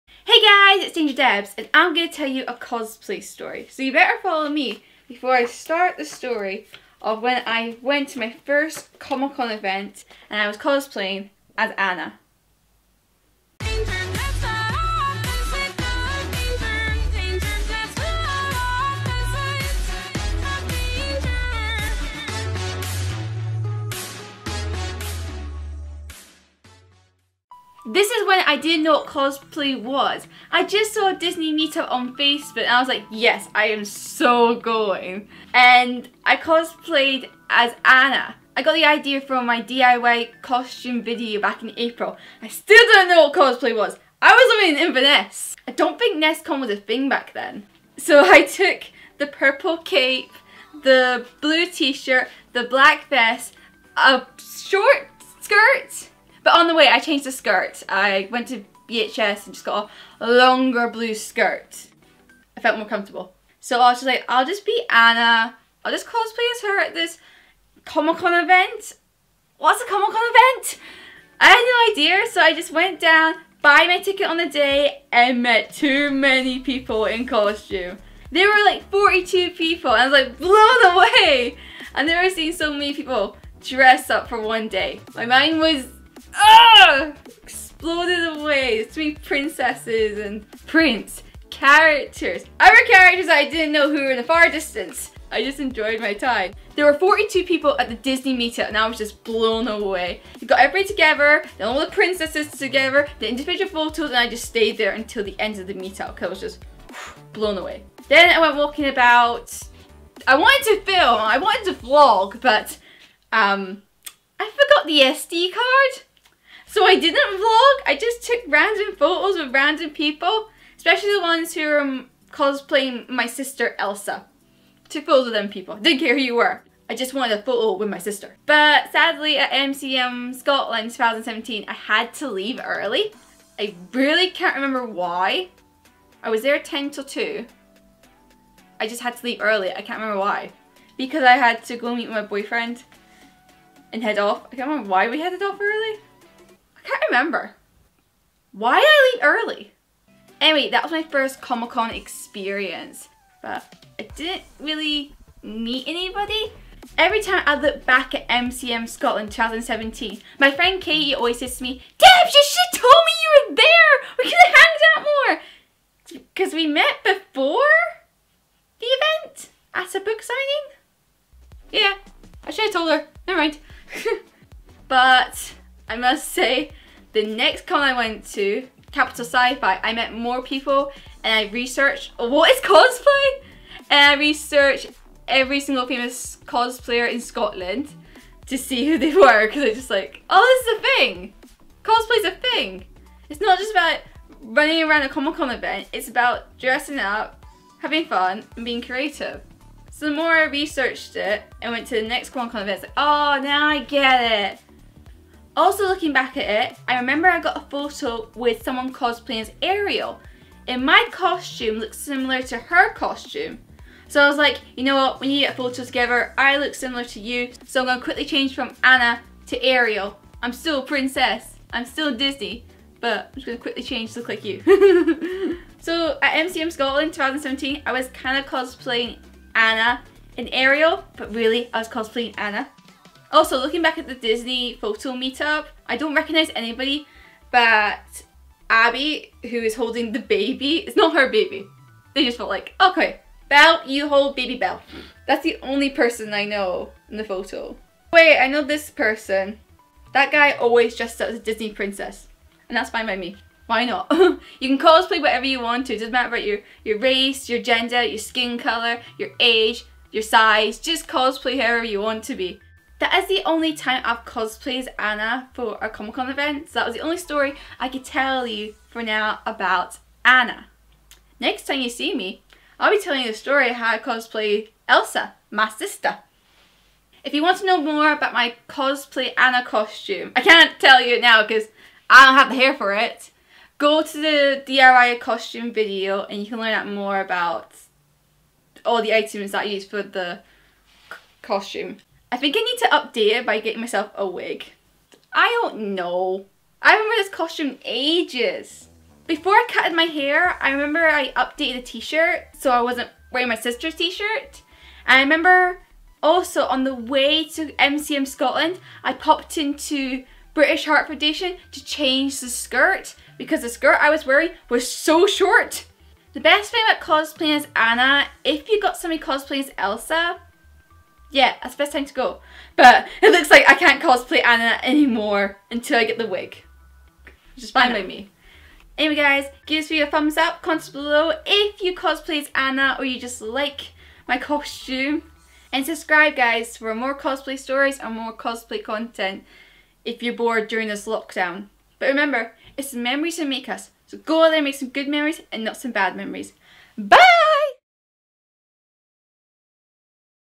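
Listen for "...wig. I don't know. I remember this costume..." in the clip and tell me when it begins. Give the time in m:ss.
4:54.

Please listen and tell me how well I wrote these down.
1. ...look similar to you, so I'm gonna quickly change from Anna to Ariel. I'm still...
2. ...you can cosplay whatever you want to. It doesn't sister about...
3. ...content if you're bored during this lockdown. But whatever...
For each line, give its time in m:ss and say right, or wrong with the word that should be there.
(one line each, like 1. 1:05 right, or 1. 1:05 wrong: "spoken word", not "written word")
1. 3:36 right
2. 4:14 wrong: "matter", not "sister"
3. 5:38 wrong: "remember", not "whatever".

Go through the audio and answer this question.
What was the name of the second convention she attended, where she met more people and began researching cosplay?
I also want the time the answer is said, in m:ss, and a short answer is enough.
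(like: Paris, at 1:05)
Capital Sci-Fi, at 2:58.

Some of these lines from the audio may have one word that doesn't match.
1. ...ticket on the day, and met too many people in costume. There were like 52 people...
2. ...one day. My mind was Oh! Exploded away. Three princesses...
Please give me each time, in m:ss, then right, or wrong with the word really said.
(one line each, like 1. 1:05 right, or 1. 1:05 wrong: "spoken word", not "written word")
1. 1:13 wrong: "42", not "52"
2. 1:24 right.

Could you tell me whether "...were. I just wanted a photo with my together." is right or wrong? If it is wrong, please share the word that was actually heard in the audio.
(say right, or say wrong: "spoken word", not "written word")
wrong: "sister", not "together".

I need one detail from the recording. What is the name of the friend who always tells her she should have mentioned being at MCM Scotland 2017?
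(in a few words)
Katie.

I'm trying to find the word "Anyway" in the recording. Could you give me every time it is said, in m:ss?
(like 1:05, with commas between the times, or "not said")
2:30, 5:28.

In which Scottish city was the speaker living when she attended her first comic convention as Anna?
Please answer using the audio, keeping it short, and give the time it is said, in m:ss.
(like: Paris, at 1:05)
Inverness, at 0:44.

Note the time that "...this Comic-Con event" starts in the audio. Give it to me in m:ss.
1:06.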